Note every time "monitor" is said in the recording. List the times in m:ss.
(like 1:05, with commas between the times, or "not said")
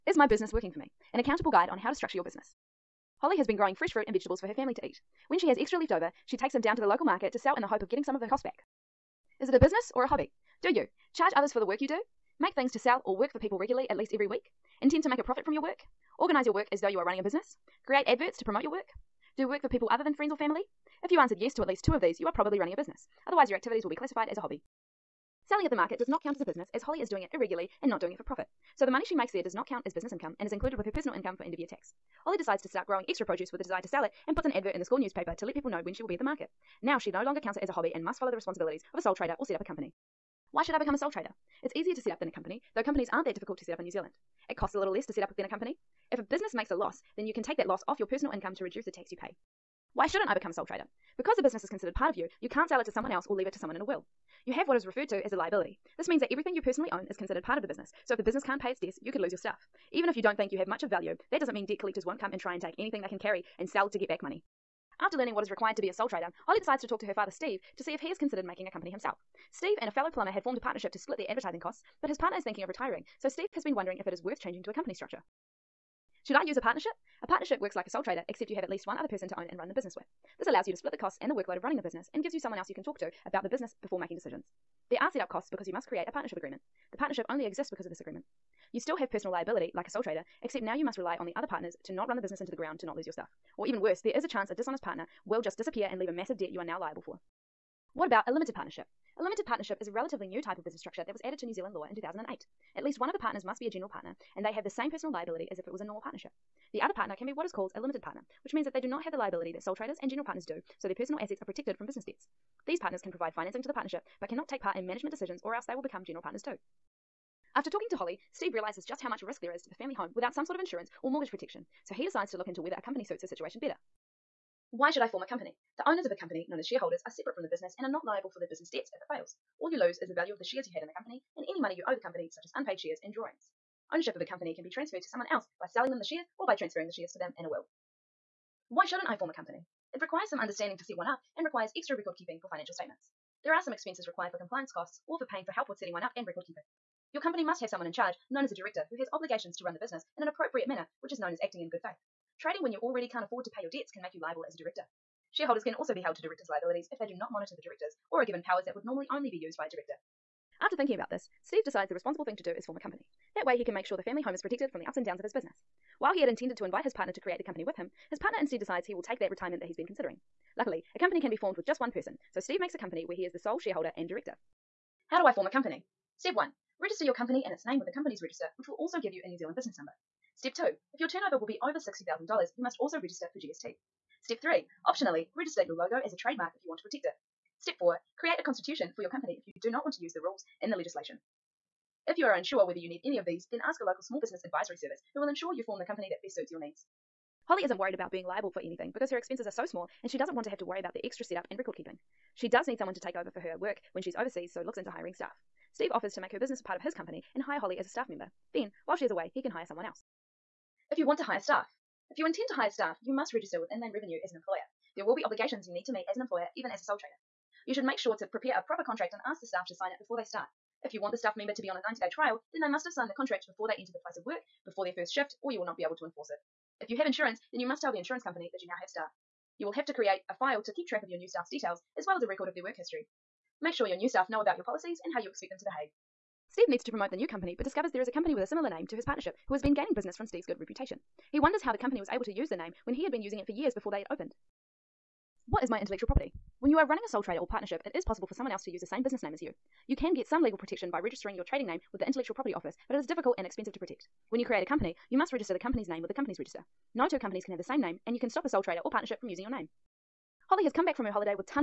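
2:37.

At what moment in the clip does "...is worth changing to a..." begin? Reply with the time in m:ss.
1:14.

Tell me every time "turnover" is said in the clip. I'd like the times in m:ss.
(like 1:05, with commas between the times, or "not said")
3:01.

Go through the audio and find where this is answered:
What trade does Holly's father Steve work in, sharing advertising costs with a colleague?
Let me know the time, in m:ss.
1:10.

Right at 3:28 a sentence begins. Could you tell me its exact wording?
Then, while she is away, he can hire someone else.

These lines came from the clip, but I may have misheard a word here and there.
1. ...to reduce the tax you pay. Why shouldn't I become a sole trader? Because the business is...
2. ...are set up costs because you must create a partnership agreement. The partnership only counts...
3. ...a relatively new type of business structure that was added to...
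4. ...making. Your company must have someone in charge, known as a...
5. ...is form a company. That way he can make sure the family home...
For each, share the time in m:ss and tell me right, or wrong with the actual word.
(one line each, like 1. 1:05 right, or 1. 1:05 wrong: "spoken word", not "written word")
1. 0:48 right
2. 1:24 wrong: "exists", not "counts"
3. 1:39 right
4. 2:26 wrong: "keeping", not "making"
5. 2:42 right.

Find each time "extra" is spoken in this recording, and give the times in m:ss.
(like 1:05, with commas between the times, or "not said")
0:05, 0:33, 2:21, 3:21.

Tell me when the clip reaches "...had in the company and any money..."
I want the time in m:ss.
2:10.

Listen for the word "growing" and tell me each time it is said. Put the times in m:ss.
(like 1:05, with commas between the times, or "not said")
0:03, 0:32.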